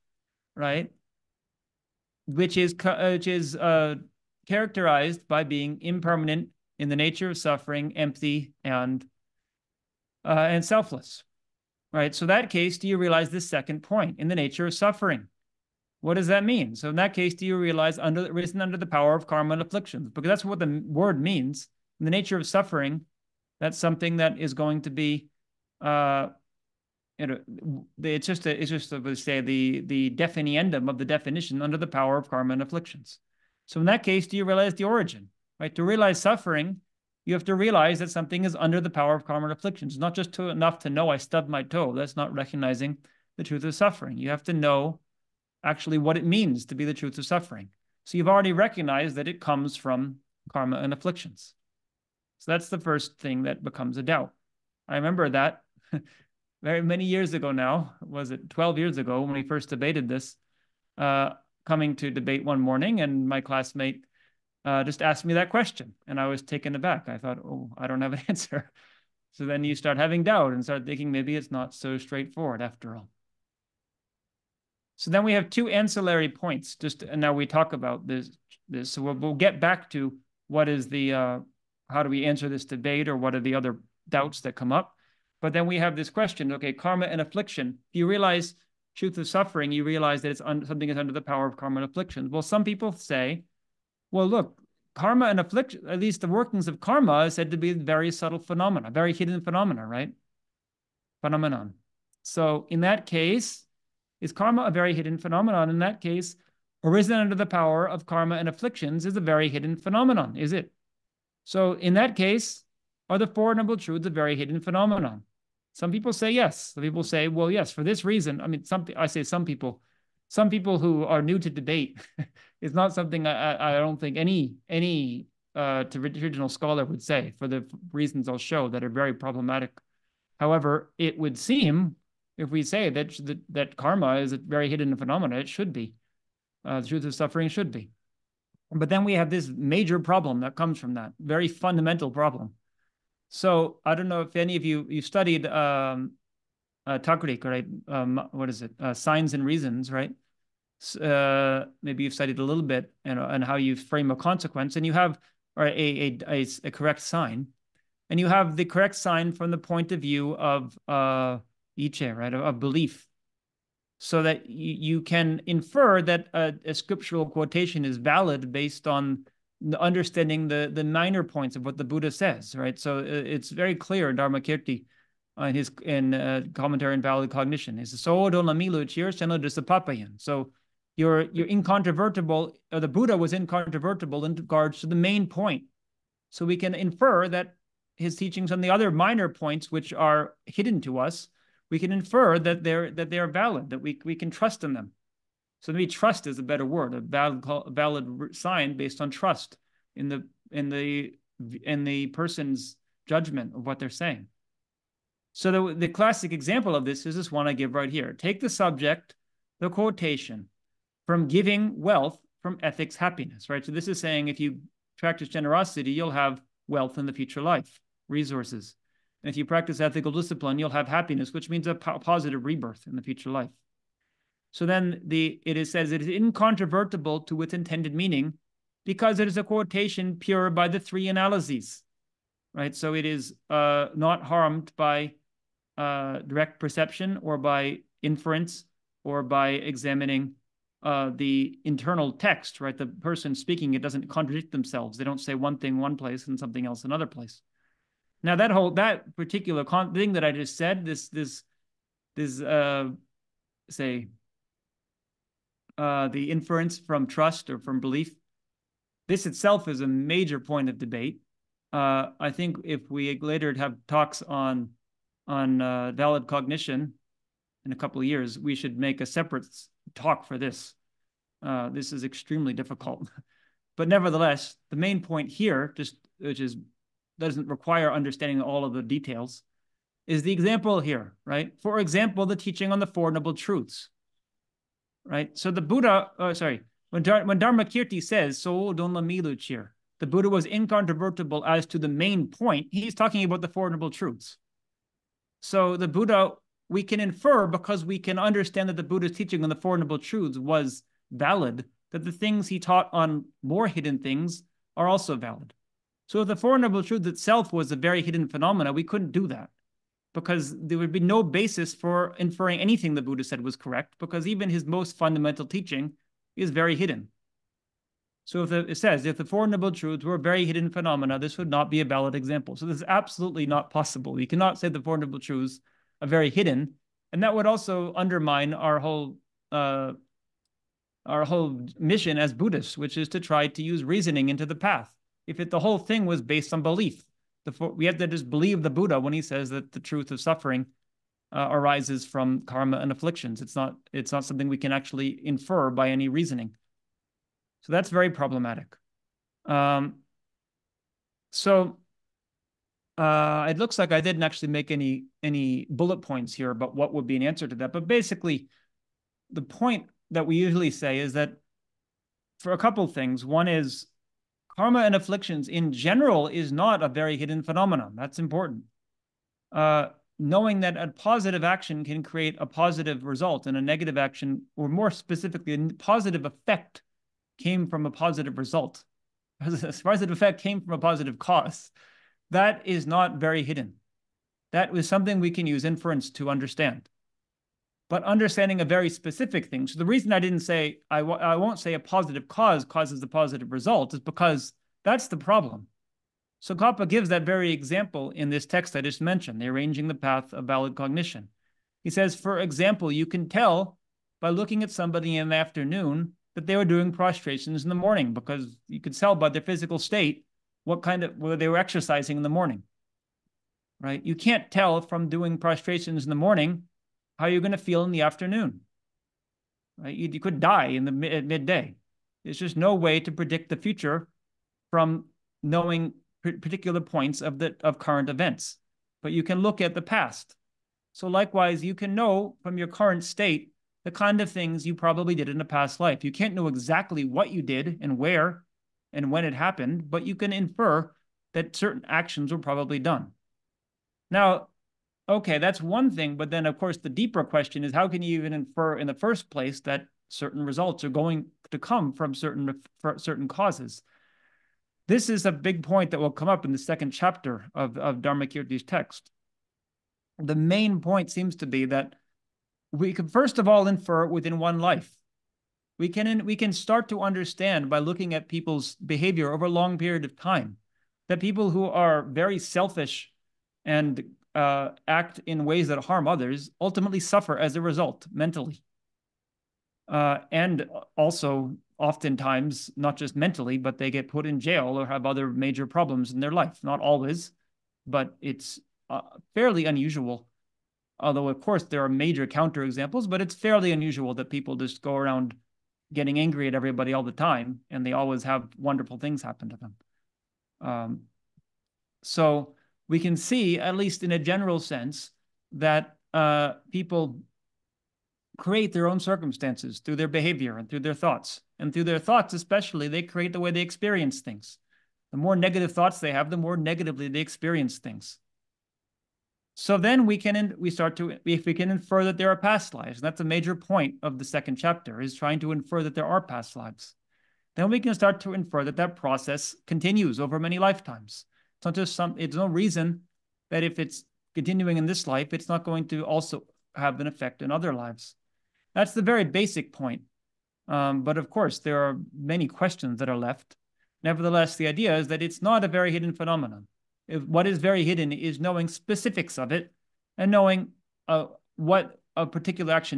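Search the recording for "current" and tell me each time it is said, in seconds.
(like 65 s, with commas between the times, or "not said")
427 s, 432 s.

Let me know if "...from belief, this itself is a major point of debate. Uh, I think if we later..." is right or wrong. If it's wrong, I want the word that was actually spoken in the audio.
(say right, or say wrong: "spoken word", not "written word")
right.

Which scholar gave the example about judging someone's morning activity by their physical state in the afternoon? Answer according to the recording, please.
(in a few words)
Tsongkhapa.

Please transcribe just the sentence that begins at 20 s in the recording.
Because that's what the word means.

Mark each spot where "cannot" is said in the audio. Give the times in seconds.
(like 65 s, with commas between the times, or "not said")
324 s.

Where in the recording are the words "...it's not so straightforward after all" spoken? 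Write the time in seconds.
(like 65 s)
71 s.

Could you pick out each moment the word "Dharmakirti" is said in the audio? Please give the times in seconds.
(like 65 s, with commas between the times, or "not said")
174 s, 287 s, 458 s.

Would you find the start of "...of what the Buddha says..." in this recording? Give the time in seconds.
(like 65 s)
171 s.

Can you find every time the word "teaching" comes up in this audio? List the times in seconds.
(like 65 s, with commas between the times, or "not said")
188 s, 282 s, 299 s, 315 s.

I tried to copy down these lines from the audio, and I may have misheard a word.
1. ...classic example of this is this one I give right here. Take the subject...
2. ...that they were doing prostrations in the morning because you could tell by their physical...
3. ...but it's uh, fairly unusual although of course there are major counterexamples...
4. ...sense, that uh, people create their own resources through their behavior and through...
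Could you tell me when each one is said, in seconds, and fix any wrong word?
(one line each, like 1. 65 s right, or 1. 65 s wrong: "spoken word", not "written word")
1. 205 s right
2. 406 s right
3. 487 s right
4. 504 s wrong: "circumstances", not "resources".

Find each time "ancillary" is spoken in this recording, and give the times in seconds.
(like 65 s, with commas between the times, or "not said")
75 s.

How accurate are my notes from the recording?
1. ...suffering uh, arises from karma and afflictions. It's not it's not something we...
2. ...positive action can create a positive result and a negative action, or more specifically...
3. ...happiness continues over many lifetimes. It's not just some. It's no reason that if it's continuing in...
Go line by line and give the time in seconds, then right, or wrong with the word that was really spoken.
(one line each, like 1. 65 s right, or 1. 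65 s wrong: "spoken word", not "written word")
1. 340 s right
2. 370 s right
3. 528 s wrong: "process", not "happiness".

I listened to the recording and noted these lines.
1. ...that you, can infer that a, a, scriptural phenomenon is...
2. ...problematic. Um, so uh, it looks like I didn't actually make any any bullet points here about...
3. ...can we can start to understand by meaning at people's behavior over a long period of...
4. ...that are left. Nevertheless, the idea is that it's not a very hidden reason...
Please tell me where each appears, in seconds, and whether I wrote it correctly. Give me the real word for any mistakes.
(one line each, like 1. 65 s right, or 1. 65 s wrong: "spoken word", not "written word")
1. 164 s wrong: "quotation", not "phenomenon"
2. 348 s right
3. 465 s wrong: "looking", not "meaning"
4. 542 s wrong: "phenomenon", not "reason".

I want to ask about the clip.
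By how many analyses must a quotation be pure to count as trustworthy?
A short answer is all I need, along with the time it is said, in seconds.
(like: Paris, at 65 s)
3, at 230 s.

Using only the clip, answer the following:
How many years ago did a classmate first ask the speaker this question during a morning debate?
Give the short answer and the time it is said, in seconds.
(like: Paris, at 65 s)
12, at 58 s.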